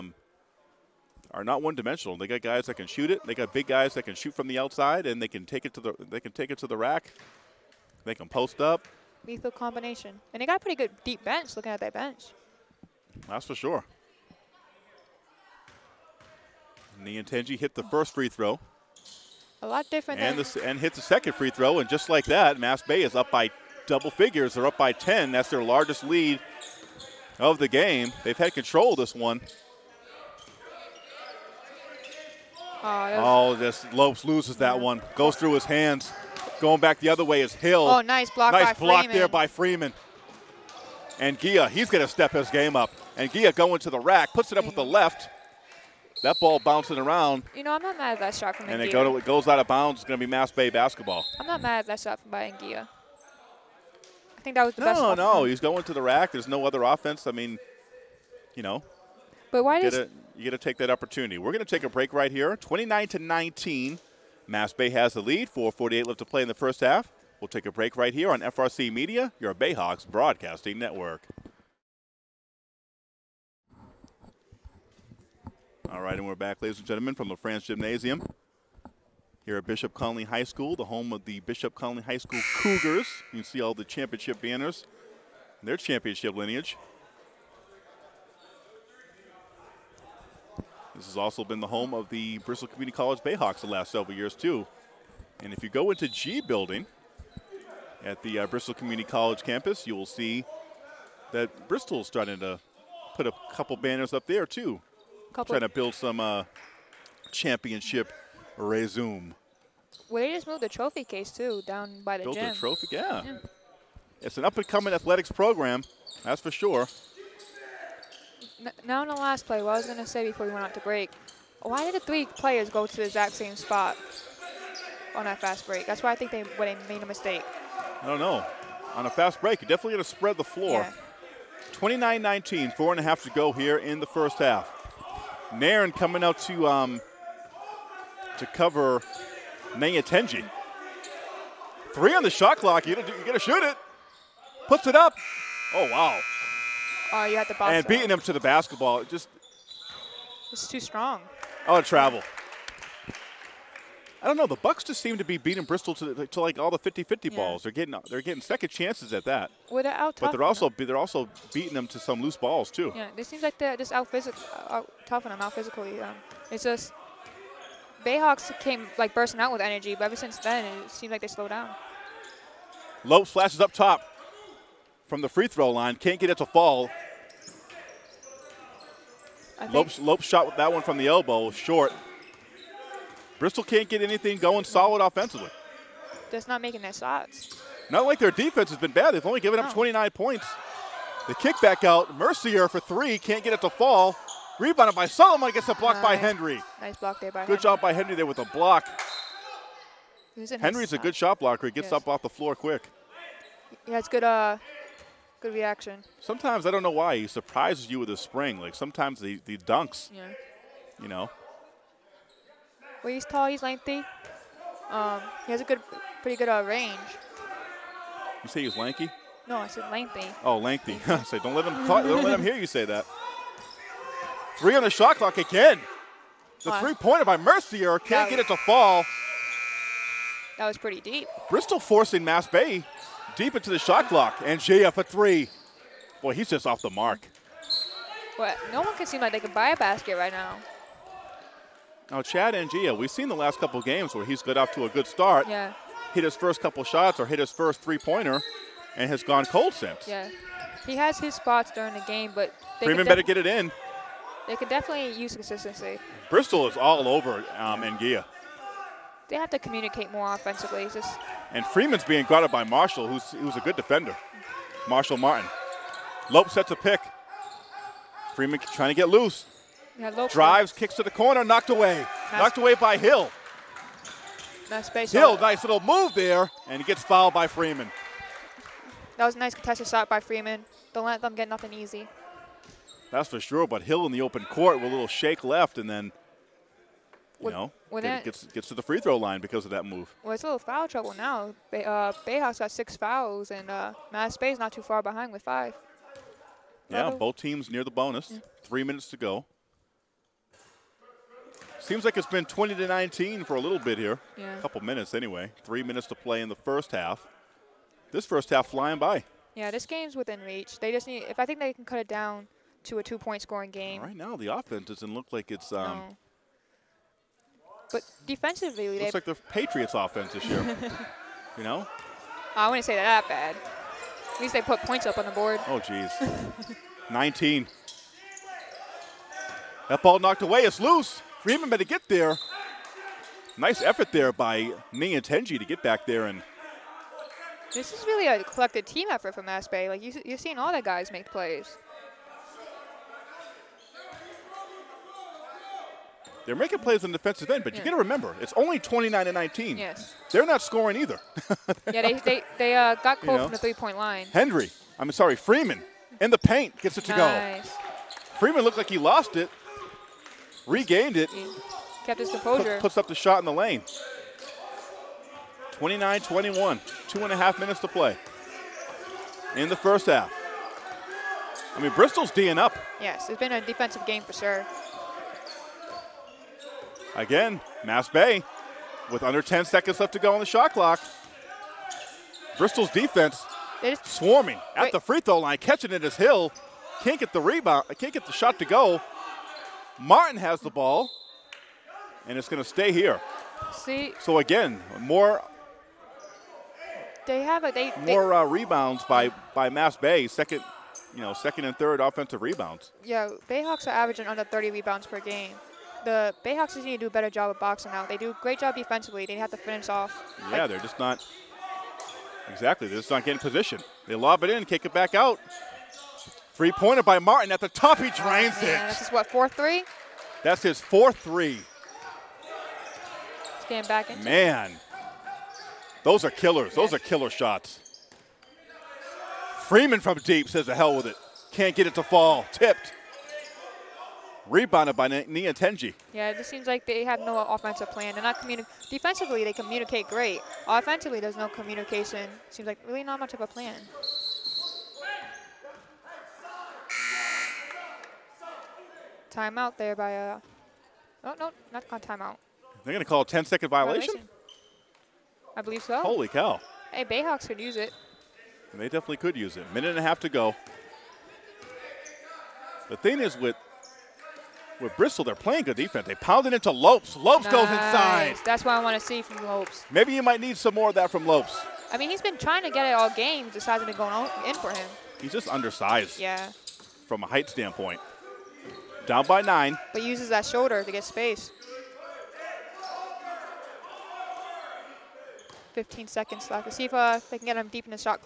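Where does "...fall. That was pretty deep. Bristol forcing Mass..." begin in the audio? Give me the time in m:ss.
3:48.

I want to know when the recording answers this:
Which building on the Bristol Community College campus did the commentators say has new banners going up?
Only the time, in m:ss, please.
1:36.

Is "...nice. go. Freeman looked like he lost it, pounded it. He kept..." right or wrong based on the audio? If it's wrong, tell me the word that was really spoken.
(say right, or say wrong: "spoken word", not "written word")
wrong: "regained", not "pounded".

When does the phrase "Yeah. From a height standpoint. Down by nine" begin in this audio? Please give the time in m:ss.
7:56.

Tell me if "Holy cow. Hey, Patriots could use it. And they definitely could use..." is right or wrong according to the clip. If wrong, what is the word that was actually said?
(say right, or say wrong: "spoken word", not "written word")
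wrong: "Bayhawks", not "Patriots".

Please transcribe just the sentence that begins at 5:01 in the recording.
Seems like it's been 20 to 19 for a little bit here.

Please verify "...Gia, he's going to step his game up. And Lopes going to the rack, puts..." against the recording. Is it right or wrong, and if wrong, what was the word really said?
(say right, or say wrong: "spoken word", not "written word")
wrong: "Gia", not "Lopes".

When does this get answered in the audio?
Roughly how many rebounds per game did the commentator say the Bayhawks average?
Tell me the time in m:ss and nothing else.
6:44.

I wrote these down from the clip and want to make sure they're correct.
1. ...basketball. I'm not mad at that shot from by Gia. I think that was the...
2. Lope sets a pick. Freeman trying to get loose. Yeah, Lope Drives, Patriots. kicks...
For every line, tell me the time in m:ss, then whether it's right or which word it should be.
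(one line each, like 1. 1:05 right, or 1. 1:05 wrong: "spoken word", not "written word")
1. 0:50 right
2. 4:26 wrong: "Lope", not "Patriots".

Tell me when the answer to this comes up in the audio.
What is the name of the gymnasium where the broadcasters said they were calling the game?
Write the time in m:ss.
1:17.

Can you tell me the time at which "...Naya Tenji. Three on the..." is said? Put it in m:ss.
2:19.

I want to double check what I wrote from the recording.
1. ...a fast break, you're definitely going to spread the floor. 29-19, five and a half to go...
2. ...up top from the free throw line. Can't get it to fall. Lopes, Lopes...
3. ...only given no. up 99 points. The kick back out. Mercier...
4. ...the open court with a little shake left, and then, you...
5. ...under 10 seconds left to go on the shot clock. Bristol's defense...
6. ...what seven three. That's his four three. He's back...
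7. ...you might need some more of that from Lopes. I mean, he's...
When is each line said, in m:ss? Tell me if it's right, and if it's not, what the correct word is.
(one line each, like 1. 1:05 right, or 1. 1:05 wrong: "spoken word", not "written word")
1. 2:09 wrong: "four", not "five"
2. 2:53 right
3. 3:09 wrong: "29", not "99"
4. 4:44 right
5. 6:19 right
6. 6:59 wrong: "four", not "seven"
7. 7:50 right.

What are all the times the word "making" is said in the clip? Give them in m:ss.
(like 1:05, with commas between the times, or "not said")
3:06, 5:46.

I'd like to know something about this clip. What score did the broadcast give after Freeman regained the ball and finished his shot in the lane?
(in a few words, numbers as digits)
29-21.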